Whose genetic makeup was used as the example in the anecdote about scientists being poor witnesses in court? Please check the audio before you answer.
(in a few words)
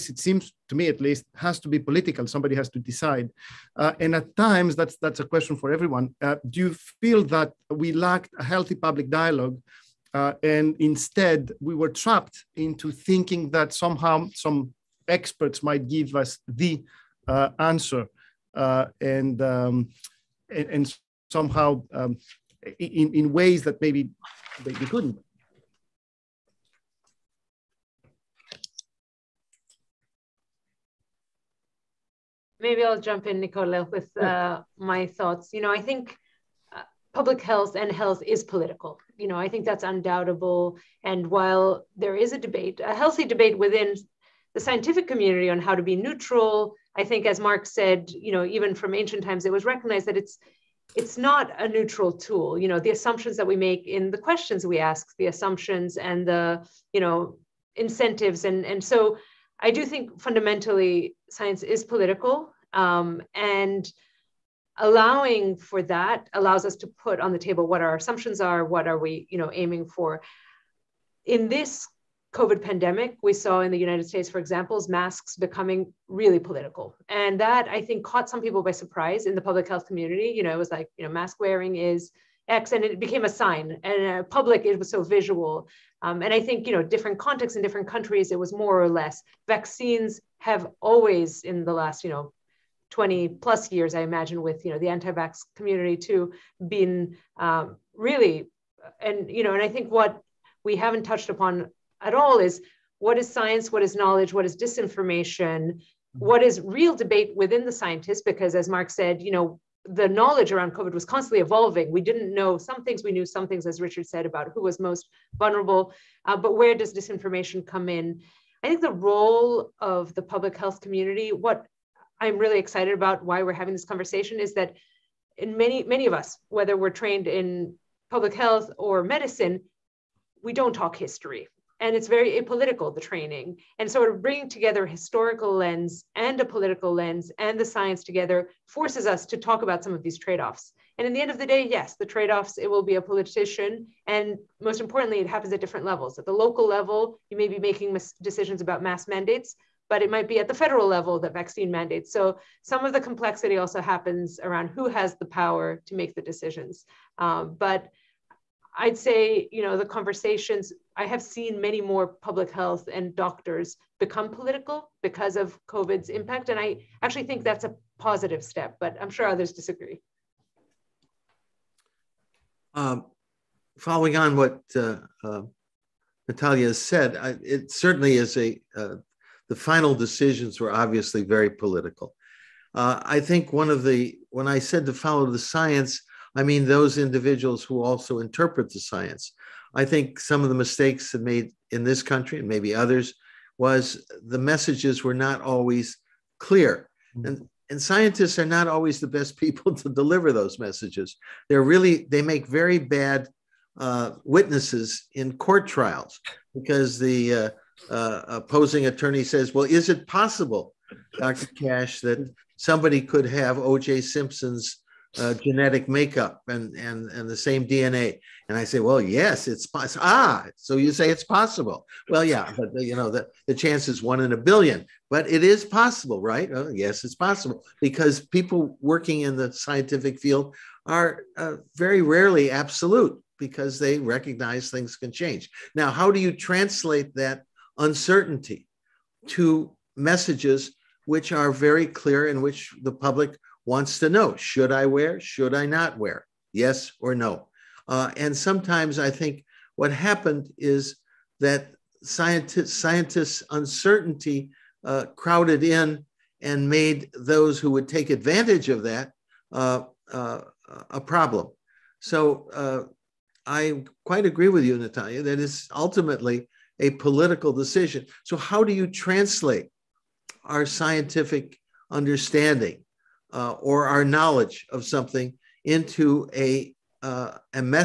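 O.J. Simpson.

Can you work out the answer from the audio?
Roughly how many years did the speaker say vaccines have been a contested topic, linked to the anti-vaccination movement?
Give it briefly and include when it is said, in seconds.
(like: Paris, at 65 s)
20 plus years, at 92 s.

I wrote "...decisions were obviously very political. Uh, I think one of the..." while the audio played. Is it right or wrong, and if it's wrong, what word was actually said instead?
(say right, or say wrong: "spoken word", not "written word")
right.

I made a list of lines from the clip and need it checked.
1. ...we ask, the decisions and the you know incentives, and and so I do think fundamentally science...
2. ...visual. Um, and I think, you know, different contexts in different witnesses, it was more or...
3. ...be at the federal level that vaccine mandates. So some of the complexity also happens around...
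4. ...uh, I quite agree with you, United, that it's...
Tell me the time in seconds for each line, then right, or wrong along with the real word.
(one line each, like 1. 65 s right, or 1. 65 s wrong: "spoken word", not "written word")
1. 54 s wrong: "assumptions", not "decisions"
2. 85 s wrong: "countries", not "witnesses"
3. 150 s right
4. 262 s wrong: "Natalia", not "United".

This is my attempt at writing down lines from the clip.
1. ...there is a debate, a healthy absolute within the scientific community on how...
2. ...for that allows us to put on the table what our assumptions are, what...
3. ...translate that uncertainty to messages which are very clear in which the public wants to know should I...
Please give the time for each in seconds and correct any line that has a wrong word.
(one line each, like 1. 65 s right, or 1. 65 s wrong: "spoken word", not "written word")
1. 41 s wrong: "debate", not "absolute"
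2. 65 s right
3. 236 s right.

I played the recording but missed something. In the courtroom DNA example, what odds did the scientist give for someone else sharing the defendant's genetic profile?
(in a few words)
1 in a billion.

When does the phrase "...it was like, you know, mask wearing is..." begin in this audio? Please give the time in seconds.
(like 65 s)
80 s.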